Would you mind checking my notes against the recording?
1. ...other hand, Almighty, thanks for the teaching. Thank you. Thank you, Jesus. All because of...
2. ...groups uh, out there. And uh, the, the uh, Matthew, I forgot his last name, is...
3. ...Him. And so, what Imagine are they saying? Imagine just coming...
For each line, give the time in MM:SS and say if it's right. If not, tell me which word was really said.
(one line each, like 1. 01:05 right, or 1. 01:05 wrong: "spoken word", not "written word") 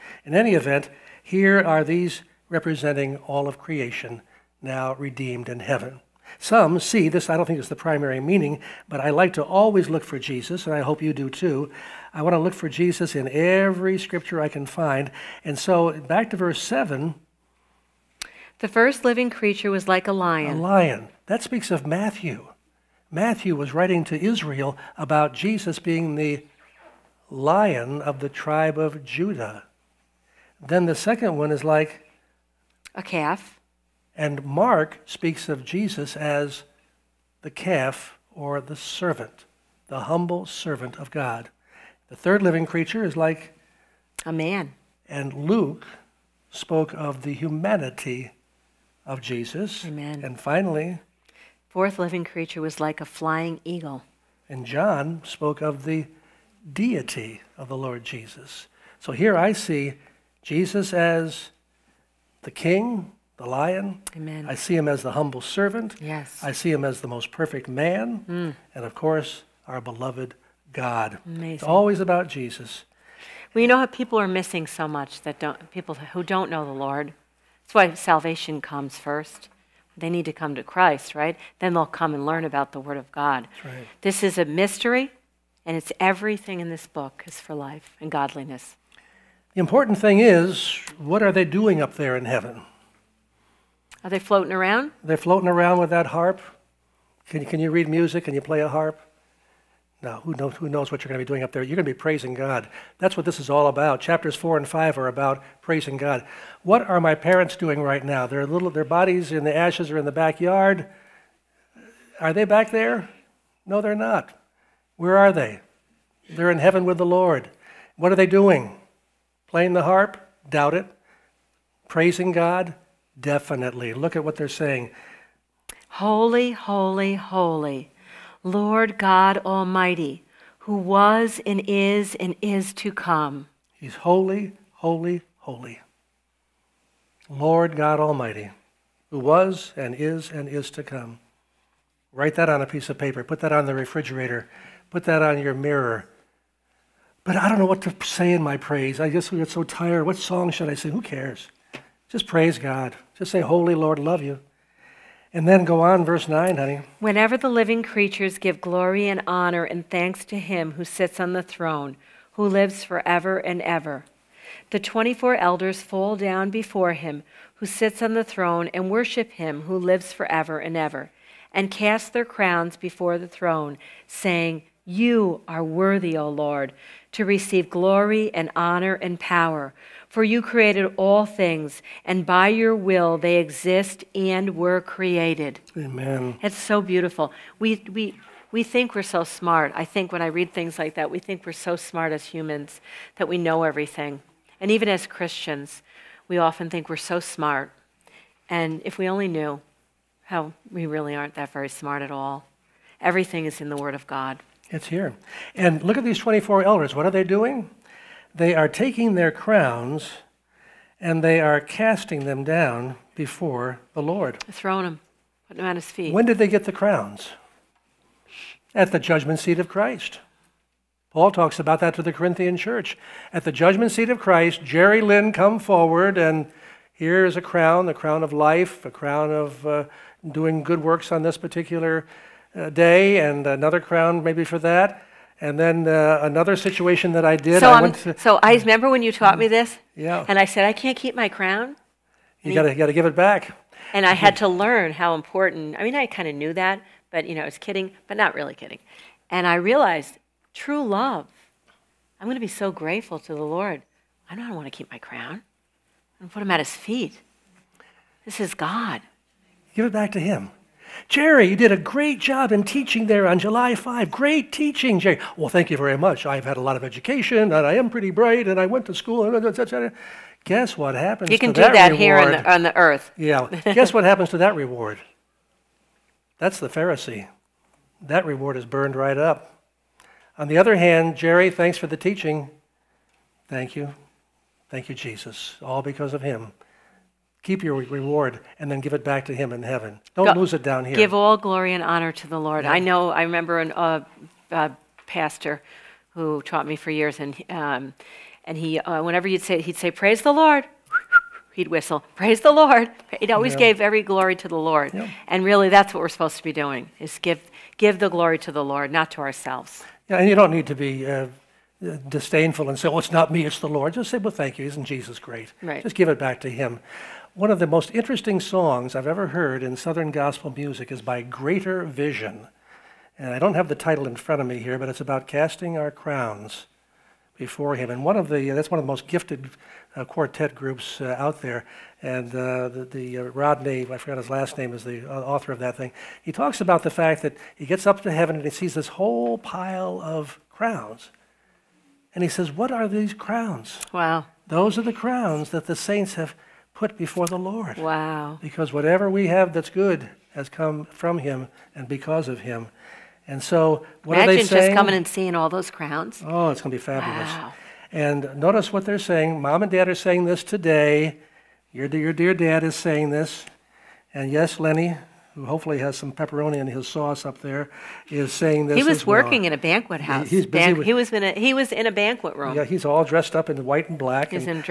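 1. 04:40 wrong: "Jerry", not "Almighty"
2. 05:30 wrong: "Rodney", not "Matthew"
3. 05:52 right.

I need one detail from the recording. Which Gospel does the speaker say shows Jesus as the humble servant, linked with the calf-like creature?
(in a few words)
Mark.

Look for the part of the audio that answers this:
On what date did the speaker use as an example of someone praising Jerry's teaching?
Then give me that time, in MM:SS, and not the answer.
04:23.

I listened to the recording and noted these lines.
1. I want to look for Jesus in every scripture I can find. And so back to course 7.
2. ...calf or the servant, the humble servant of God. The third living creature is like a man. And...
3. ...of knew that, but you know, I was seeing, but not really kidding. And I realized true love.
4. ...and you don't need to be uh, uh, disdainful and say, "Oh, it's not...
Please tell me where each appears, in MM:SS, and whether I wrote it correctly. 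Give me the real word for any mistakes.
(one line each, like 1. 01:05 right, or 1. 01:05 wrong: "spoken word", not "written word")
1. 00:12 wrong: "verse", not "course"
2. 00:37 right
3. 04:06 wrong: "kidding", not "seeing"
4. 05:10 right.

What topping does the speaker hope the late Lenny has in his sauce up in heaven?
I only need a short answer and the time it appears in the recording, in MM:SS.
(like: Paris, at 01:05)
Pepperoni, at 06:06.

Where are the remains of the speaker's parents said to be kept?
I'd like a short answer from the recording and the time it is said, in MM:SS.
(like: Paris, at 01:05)
In the backyard, at 01:49.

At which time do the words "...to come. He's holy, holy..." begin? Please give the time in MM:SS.
02:12.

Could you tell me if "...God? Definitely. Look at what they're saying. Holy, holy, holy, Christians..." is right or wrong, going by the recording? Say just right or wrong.
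wrong.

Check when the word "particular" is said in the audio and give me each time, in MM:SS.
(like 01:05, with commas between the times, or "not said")
03:51.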